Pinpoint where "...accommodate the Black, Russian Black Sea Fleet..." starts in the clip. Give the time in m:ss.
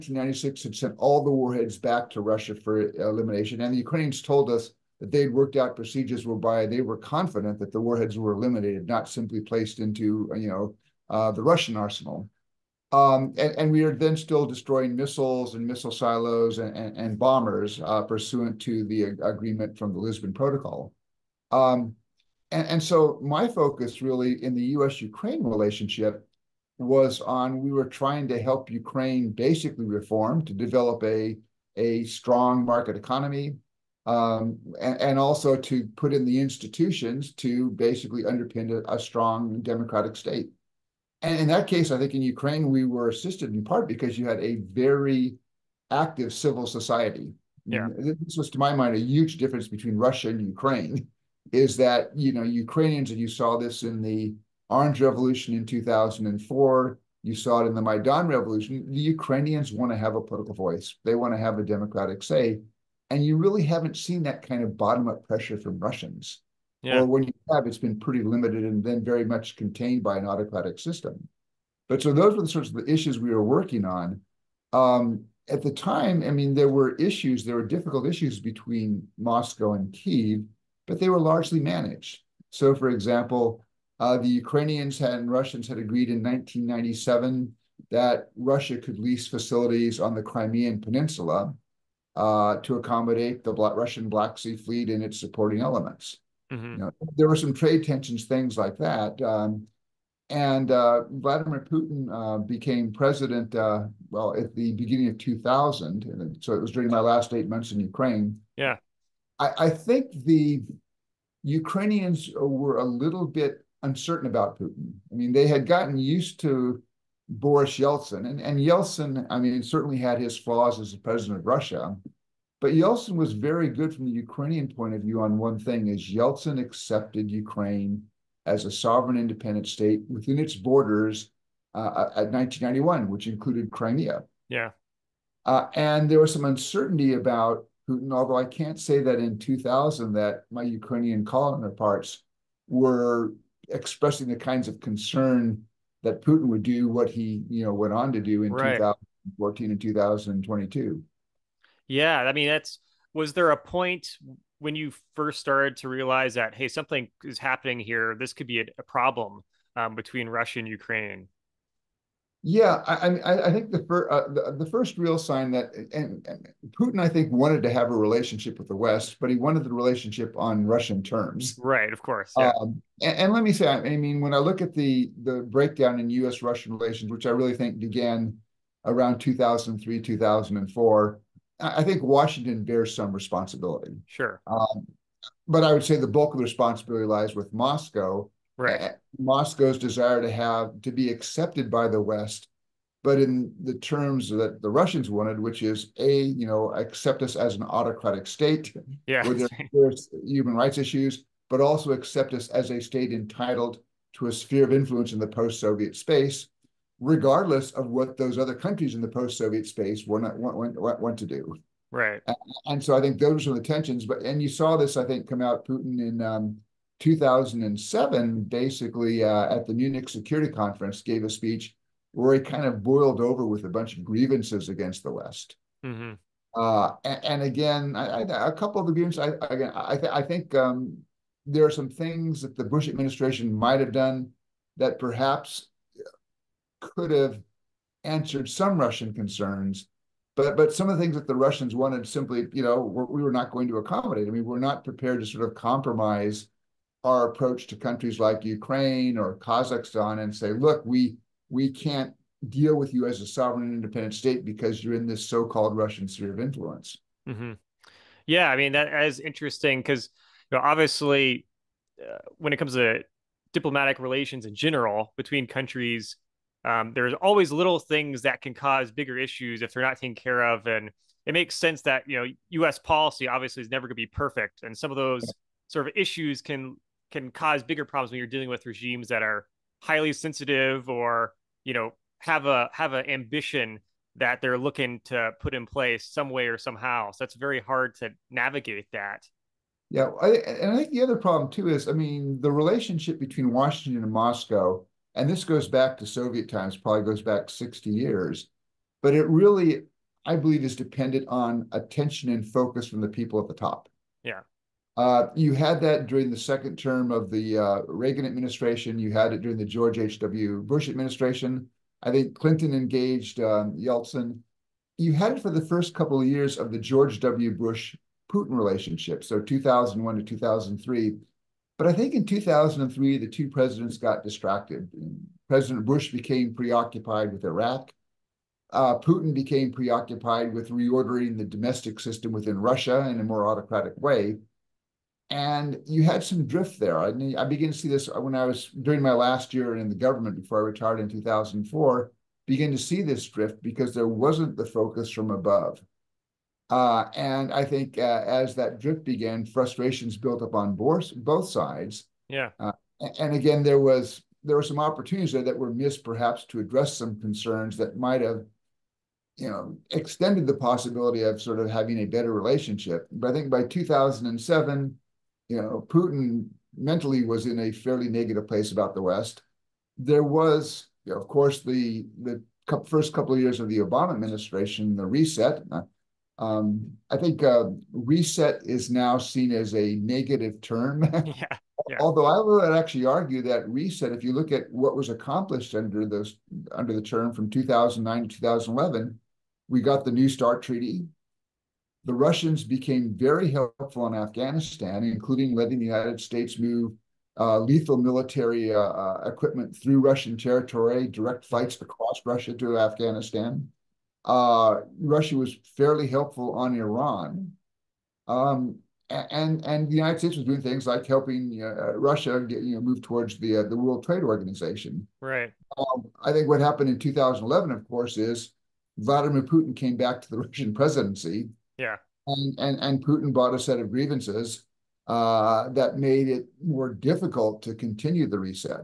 1:32.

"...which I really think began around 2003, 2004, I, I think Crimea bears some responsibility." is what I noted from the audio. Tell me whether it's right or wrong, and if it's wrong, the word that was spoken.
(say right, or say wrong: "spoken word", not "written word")
wrong: "Washington", not "Crimea".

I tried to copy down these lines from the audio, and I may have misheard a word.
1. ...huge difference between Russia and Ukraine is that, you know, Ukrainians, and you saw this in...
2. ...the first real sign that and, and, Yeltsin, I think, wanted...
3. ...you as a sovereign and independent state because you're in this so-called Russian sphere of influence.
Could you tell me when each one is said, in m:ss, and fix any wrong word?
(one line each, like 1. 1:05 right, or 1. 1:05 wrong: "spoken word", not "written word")
1. 0:48 right
2. 2:44 wrong: "Putin", not "Yeltsin"
3. 4:12 right.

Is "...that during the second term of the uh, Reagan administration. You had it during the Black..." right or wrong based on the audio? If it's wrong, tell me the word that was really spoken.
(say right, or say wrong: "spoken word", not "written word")
wrong: "George", not "Black".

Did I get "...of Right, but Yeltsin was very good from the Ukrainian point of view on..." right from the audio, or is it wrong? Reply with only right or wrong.
wrong.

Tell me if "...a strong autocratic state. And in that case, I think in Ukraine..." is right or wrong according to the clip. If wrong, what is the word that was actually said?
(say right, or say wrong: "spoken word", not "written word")
wrong: "democratic", not "autocratic".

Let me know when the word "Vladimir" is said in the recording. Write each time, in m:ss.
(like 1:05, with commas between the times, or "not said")
1:41, 6:58.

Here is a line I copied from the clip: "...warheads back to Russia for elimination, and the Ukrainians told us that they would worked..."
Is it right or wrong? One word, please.
right.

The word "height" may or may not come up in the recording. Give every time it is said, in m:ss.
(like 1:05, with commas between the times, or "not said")
not said.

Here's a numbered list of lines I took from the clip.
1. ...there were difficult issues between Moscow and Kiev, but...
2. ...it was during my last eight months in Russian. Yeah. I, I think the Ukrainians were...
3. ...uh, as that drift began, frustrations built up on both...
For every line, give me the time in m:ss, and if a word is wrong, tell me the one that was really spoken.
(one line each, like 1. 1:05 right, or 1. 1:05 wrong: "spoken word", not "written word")
1. 1:17 right
2. 1:46 wrong: "Ukraine", not "Russian"
3. 5:47 right.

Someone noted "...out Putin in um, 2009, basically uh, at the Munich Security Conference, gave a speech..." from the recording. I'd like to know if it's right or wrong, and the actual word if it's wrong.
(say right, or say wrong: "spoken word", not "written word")
wrong: "2007", not "2009".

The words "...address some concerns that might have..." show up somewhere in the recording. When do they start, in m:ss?
5:56.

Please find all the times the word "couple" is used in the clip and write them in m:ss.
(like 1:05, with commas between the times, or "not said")
3:48, 5:15, 6:13.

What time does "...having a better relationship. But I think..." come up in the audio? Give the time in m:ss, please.
6:01.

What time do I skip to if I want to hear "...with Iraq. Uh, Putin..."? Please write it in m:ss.
5:27.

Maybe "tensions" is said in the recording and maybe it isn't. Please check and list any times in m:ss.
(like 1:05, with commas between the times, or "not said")
1:37, 3:33.